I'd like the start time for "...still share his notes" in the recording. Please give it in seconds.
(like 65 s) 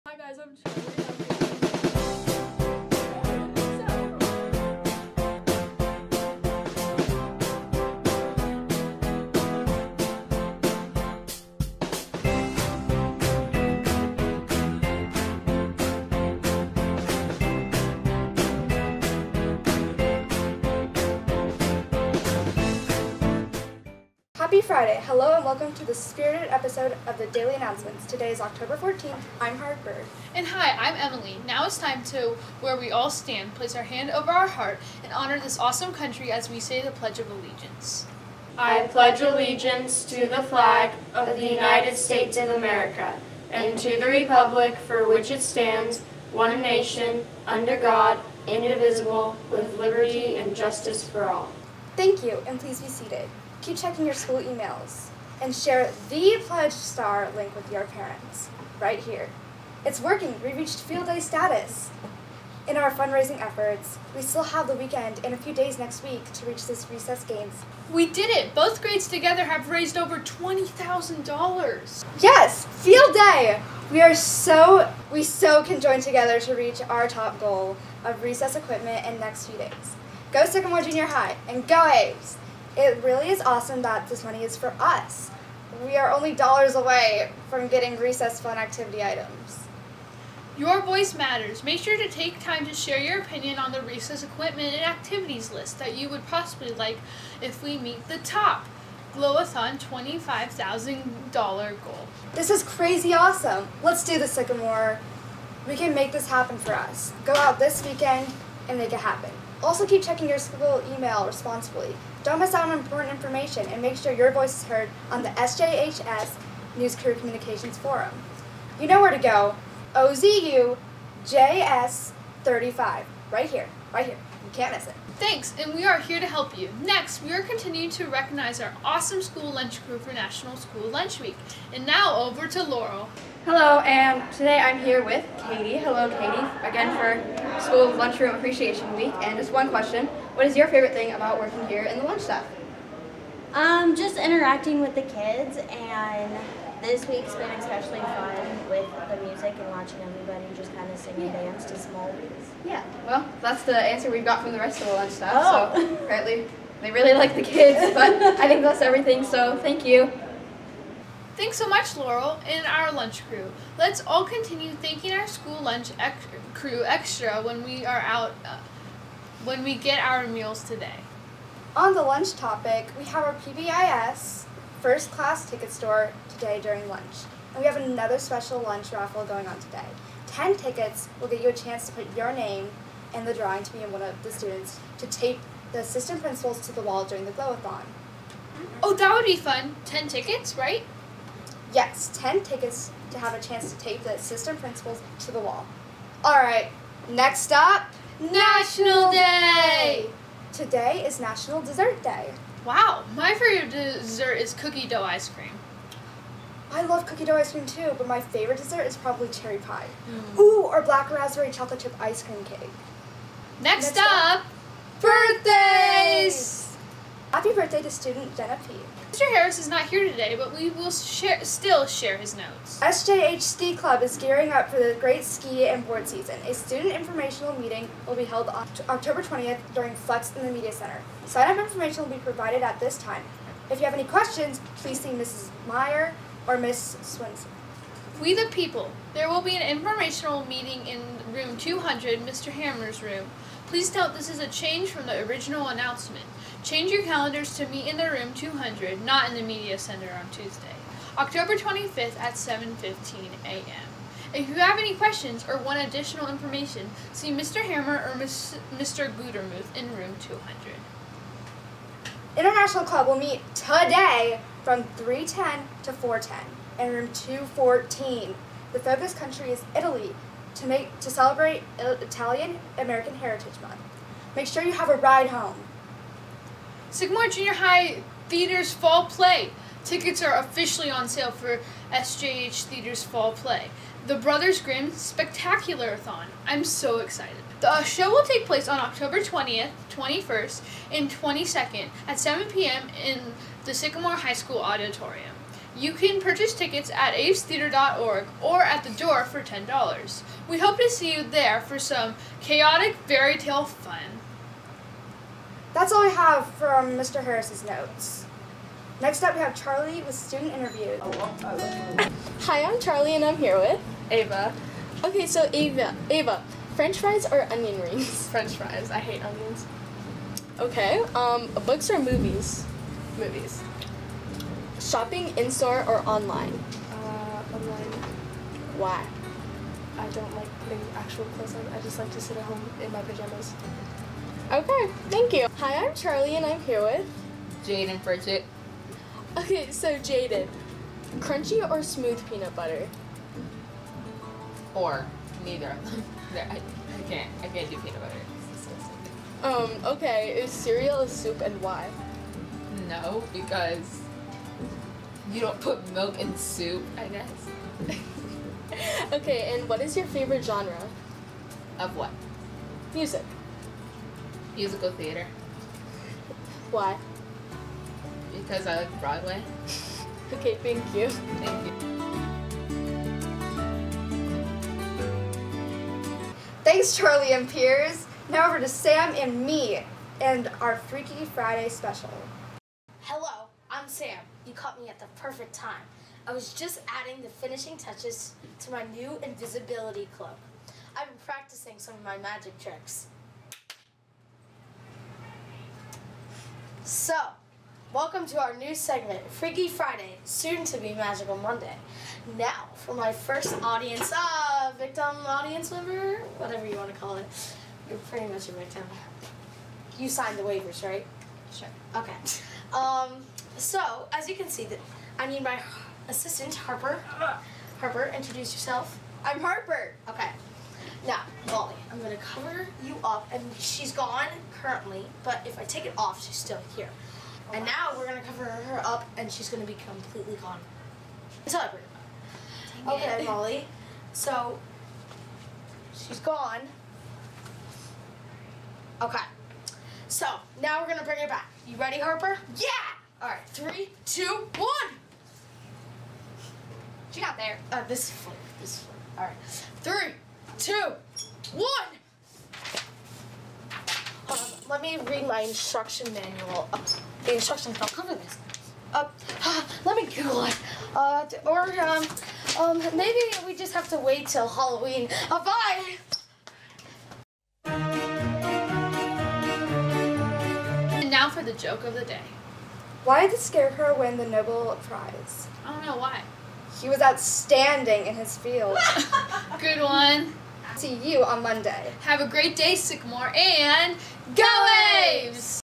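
221 s.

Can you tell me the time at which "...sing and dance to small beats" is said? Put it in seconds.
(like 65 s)
150 s.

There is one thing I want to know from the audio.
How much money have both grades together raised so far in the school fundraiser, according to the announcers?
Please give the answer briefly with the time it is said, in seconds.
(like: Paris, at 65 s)
$20,000, at 69 s.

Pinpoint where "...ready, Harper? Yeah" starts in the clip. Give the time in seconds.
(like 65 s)
441 s.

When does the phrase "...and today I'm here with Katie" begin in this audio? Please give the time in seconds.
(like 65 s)
133 s.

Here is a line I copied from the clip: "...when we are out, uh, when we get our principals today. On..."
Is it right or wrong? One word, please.
wrong.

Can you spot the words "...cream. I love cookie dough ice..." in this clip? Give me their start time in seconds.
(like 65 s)
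205 s.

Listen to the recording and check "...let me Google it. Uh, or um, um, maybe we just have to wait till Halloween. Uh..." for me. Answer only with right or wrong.
right.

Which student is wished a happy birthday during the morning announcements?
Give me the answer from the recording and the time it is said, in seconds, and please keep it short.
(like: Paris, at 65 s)
Jenna P., at 218 s.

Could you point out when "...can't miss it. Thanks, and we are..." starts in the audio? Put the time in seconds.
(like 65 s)
124 s.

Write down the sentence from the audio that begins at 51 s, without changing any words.
Thank you, and please be seated keep checking your school emails, and share the Pledge Star link with your parents right here.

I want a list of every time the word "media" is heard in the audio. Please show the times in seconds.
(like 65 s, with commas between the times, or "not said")
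230 s, 249 s.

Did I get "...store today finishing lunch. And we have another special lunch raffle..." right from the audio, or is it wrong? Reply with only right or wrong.
wrong.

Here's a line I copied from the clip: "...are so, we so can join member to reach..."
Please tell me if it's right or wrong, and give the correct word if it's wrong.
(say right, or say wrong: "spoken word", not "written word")
wrong: "together", not "member".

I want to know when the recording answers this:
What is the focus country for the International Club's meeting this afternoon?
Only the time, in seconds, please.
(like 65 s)
269 s.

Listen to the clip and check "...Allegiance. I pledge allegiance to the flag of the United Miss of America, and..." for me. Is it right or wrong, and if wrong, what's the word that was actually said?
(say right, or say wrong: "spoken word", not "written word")
wrong: "States", not "Miss".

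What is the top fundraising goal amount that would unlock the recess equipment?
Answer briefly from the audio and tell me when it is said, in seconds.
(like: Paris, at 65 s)
$25,000, at 99 s.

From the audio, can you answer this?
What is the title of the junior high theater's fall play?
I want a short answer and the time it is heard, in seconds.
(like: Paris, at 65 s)
The Brothers Grimm Spectaculathon, at 284 s.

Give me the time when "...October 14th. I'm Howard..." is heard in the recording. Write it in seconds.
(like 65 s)
28 s.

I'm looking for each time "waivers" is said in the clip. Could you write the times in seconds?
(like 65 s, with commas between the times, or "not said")
410 s.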